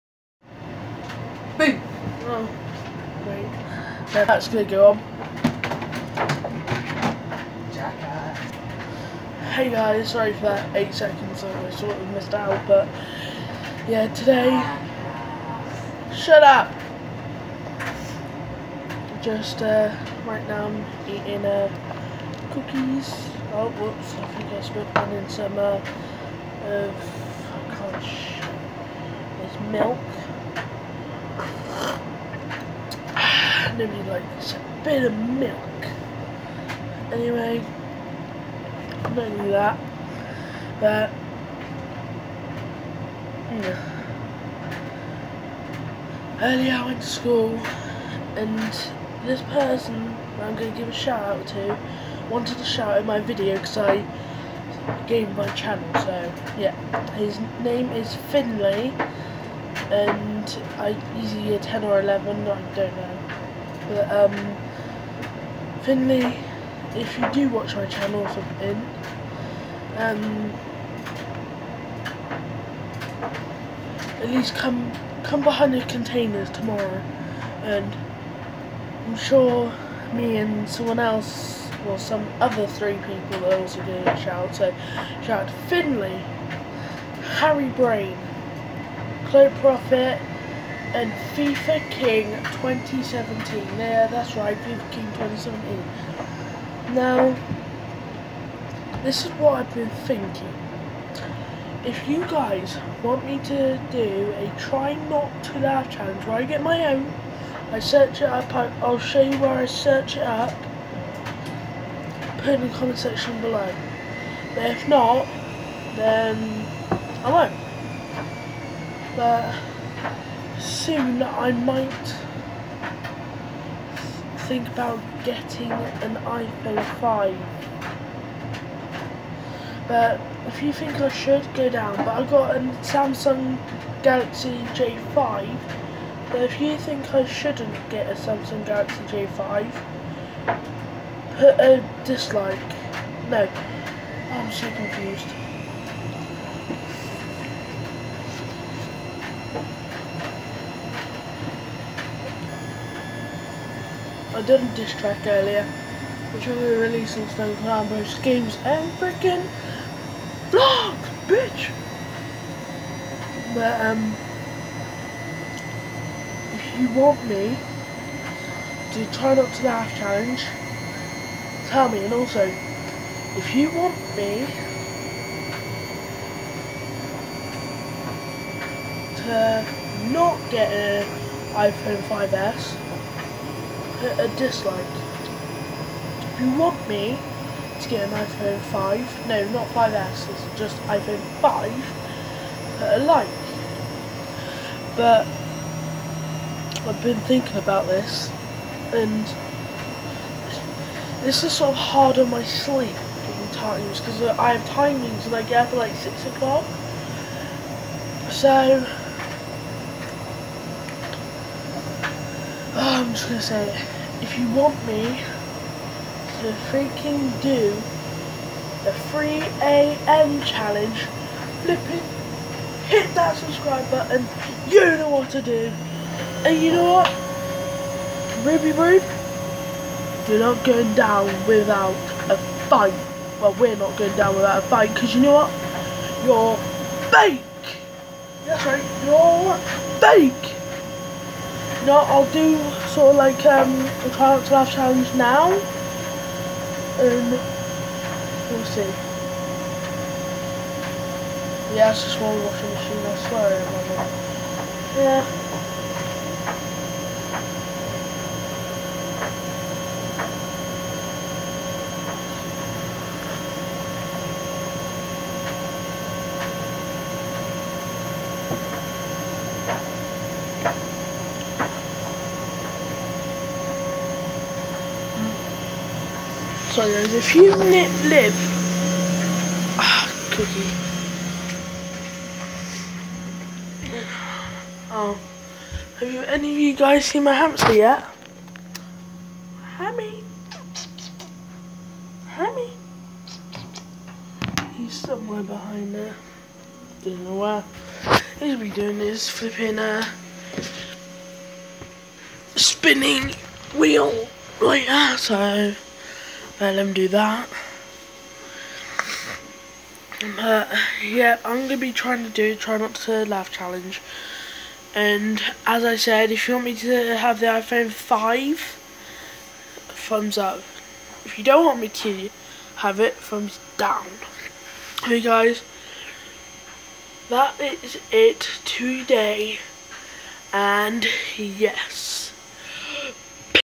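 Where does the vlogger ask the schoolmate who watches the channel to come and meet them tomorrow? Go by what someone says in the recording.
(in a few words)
behind the containers.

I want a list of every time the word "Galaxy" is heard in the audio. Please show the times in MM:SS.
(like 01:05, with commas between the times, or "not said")
02:14, 02:18.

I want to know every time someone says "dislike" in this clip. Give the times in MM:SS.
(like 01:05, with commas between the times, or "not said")
02:22, 03:04.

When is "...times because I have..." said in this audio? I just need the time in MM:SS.
03:23.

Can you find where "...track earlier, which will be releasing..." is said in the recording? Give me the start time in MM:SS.
02:34.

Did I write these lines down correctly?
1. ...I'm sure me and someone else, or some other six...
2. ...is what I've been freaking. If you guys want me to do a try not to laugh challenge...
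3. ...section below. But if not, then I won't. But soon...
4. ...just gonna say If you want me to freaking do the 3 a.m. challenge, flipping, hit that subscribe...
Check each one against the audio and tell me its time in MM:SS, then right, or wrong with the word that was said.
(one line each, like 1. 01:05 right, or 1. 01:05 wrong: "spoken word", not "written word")
1. 01:19 wrong: "three", not "six"
2. 01:39 wrong: "thinking", not "freaking"
3. 01:52 right
4. 03:33 right.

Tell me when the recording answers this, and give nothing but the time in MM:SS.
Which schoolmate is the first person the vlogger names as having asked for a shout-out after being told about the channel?
00:58.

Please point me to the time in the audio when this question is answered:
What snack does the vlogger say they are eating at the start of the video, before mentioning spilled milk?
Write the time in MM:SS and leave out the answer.
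00:22.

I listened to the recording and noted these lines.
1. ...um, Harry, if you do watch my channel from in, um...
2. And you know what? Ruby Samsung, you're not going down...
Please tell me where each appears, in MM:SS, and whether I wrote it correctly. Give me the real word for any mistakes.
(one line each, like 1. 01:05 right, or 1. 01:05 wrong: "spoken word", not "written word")
1. 01:04 wrong: "Finley", not "Harry"
2. 03:46 wrong: "Rube", not "Samsung".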